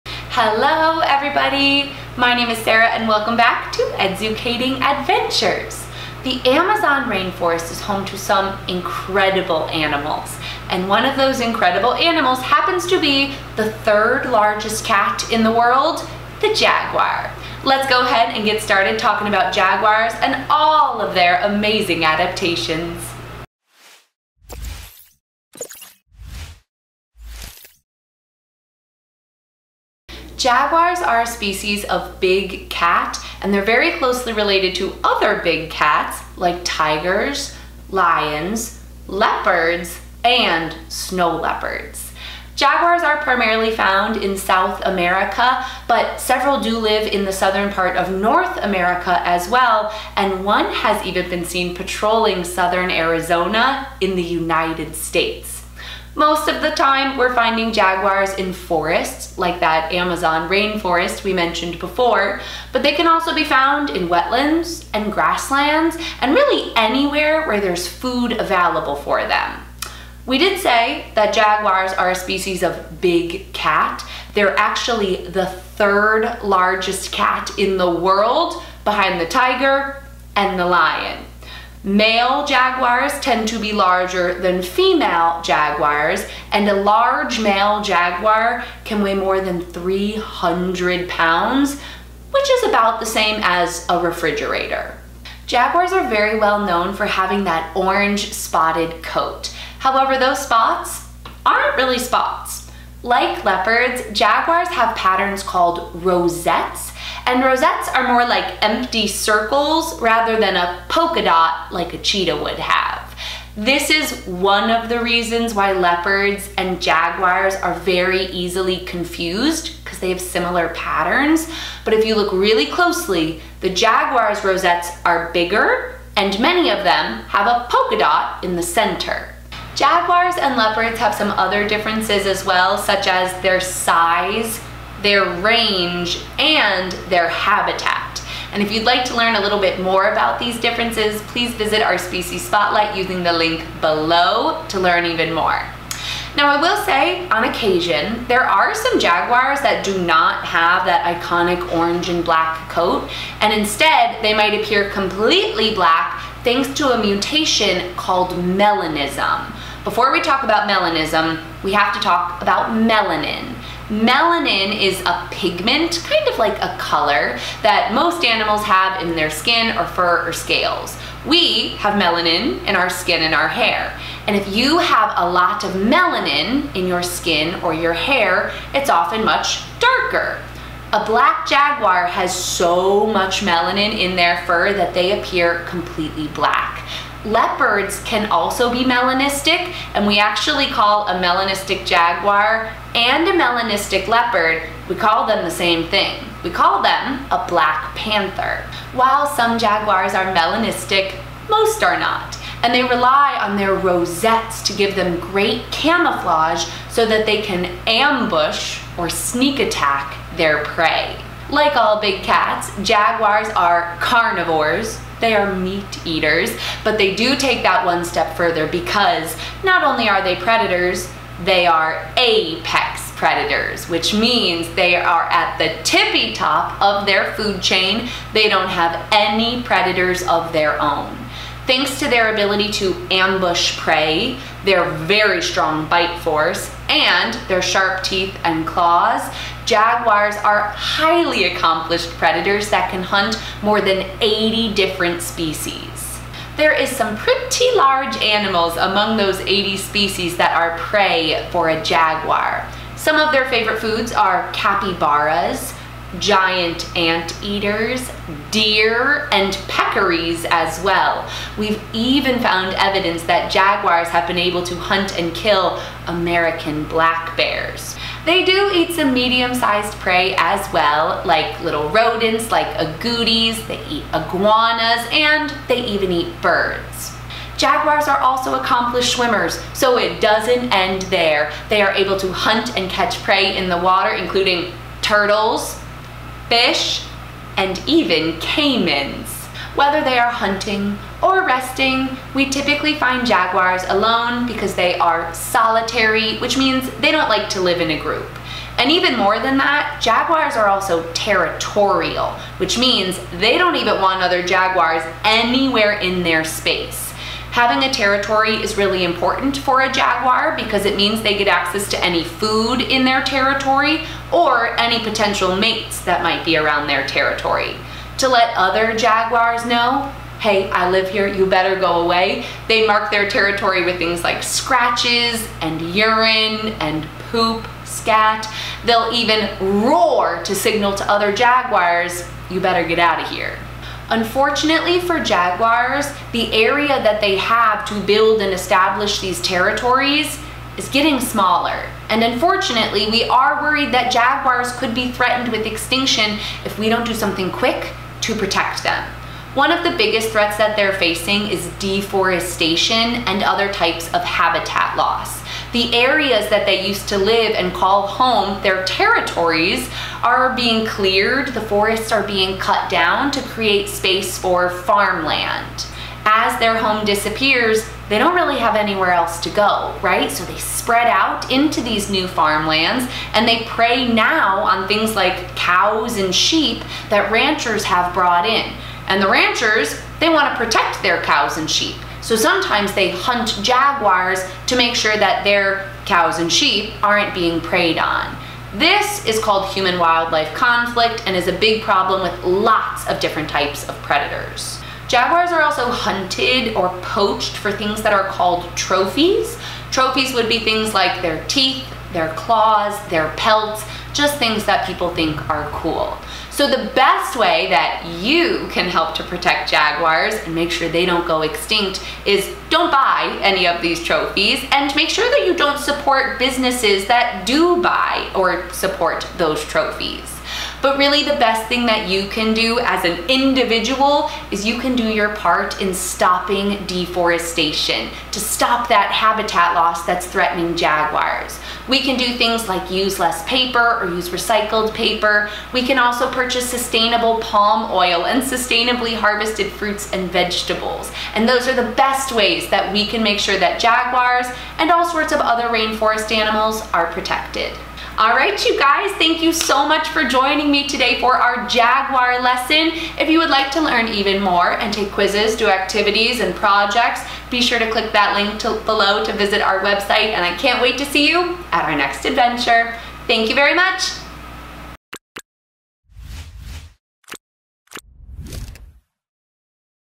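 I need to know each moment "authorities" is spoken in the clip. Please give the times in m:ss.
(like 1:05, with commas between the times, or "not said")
not said.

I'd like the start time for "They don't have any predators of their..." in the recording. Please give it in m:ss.
3:48.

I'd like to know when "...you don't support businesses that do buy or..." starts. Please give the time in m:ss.
6:55.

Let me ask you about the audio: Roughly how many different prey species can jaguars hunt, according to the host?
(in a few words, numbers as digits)
More than 80.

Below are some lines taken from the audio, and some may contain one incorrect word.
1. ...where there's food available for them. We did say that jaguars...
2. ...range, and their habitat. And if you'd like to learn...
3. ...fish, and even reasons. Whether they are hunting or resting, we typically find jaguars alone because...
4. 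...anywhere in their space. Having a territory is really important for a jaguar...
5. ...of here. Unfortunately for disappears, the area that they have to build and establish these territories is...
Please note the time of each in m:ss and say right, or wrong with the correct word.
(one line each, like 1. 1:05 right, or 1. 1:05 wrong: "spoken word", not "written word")
1. 1:07 right
2. 2:15 right
3. 4:46 wrong: "caimans", not "reasons"
4. 5:05 right
5. 5:33 wrong: "jaguars", not "disappears".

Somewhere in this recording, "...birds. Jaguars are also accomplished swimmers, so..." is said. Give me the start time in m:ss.
4:36.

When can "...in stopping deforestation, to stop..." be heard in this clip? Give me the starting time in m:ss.
7:05.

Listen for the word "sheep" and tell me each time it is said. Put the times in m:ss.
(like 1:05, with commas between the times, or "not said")
6:16, 6:21, 6:26.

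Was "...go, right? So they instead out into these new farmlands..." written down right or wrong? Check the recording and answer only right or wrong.
wrong.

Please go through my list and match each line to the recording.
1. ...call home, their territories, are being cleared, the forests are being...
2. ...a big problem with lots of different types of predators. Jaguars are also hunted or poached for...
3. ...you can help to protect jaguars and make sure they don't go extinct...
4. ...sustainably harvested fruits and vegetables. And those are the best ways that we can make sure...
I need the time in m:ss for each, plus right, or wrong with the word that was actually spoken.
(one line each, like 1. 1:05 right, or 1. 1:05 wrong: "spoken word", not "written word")
1. 5:57 right
2. 6:31 right
3. 6:48 right
4. 7:18 right.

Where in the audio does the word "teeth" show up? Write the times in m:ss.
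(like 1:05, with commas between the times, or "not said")
3:58, 6:41.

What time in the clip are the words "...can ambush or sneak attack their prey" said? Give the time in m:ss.
3:27.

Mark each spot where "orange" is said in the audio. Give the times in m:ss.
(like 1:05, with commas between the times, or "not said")
1:37, 2:31.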